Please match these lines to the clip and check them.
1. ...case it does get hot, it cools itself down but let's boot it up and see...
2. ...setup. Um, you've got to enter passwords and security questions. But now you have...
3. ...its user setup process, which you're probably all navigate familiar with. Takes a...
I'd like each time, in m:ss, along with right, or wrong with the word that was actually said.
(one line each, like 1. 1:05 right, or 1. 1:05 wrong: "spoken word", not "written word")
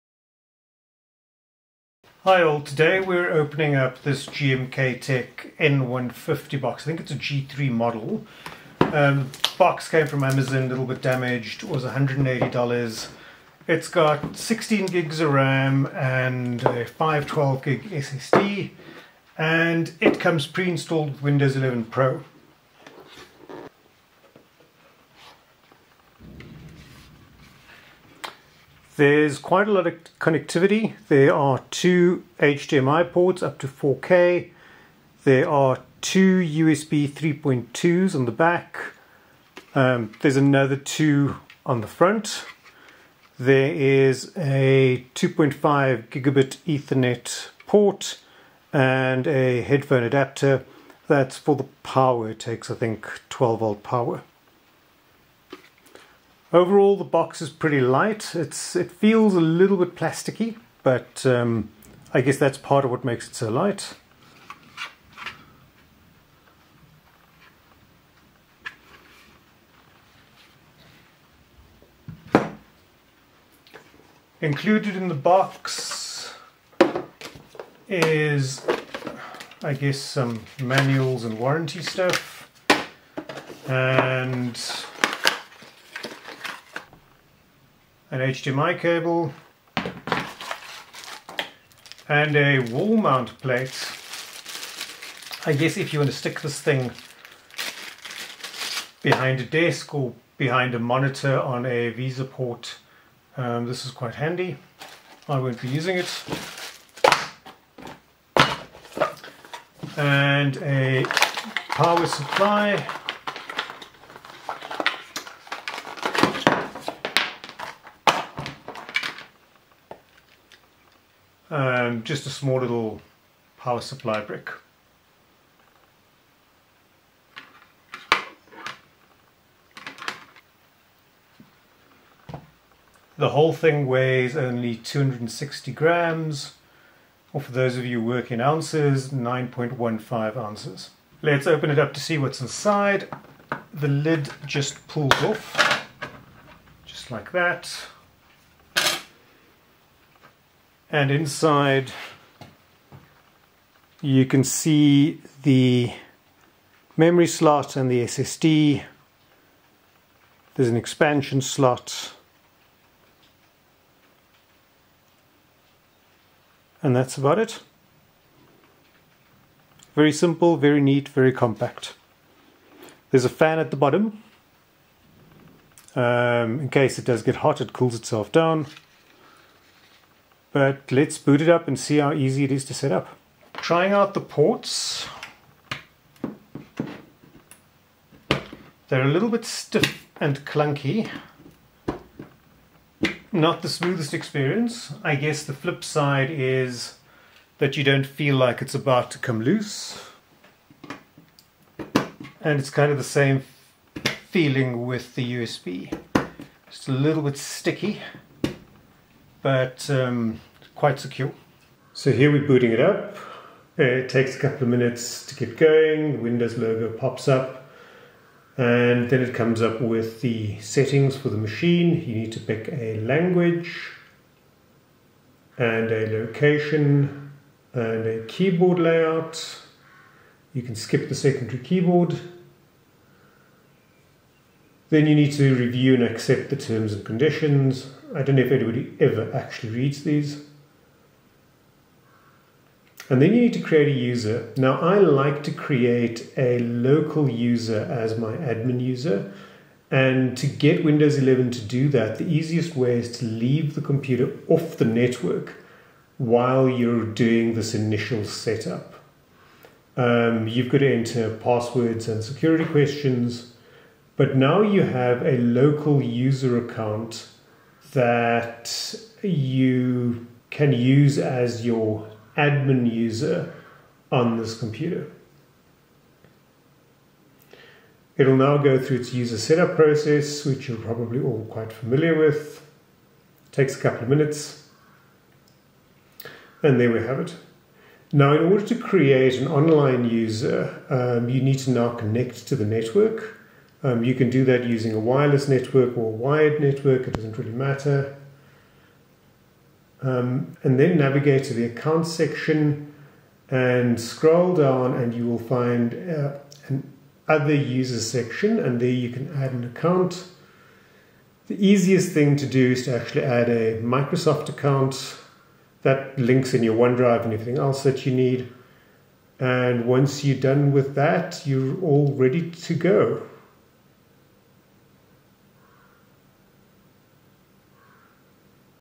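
1. 2:56 right
2. 4:18 right
3. 4:38 wrong: "quite", not "navigate".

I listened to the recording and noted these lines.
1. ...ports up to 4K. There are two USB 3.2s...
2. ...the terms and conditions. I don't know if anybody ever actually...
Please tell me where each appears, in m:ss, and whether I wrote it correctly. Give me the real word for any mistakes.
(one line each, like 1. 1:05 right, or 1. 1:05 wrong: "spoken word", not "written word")
1. 0:33 right
2. 3:56 right.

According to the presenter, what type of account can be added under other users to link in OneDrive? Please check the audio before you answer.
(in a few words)
Microsoft account.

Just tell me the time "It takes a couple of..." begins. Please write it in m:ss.
3:33.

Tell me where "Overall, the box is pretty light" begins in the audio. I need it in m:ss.
0:56.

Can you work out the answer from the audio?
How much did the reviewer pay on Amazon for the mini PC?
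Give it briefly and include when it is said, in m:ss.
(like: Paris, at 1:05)
$180, at 0:11.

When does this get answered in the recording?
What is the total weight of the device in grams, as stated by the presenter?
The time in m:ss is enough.
2:14.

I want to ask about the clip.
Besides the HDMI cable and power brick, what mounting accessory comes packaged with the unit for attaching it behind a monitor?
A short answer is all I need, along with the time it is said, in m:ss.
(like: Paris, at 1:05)
wall mount plate, at 1:32.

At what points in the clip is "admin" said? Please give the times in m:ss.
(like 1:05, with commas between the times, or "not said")
4:08, 4:32.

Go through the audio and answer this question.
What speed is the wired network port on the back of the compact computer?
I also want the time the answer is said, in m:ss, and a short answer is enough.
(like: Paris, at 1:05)
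2.5 gigabit, at 0:45.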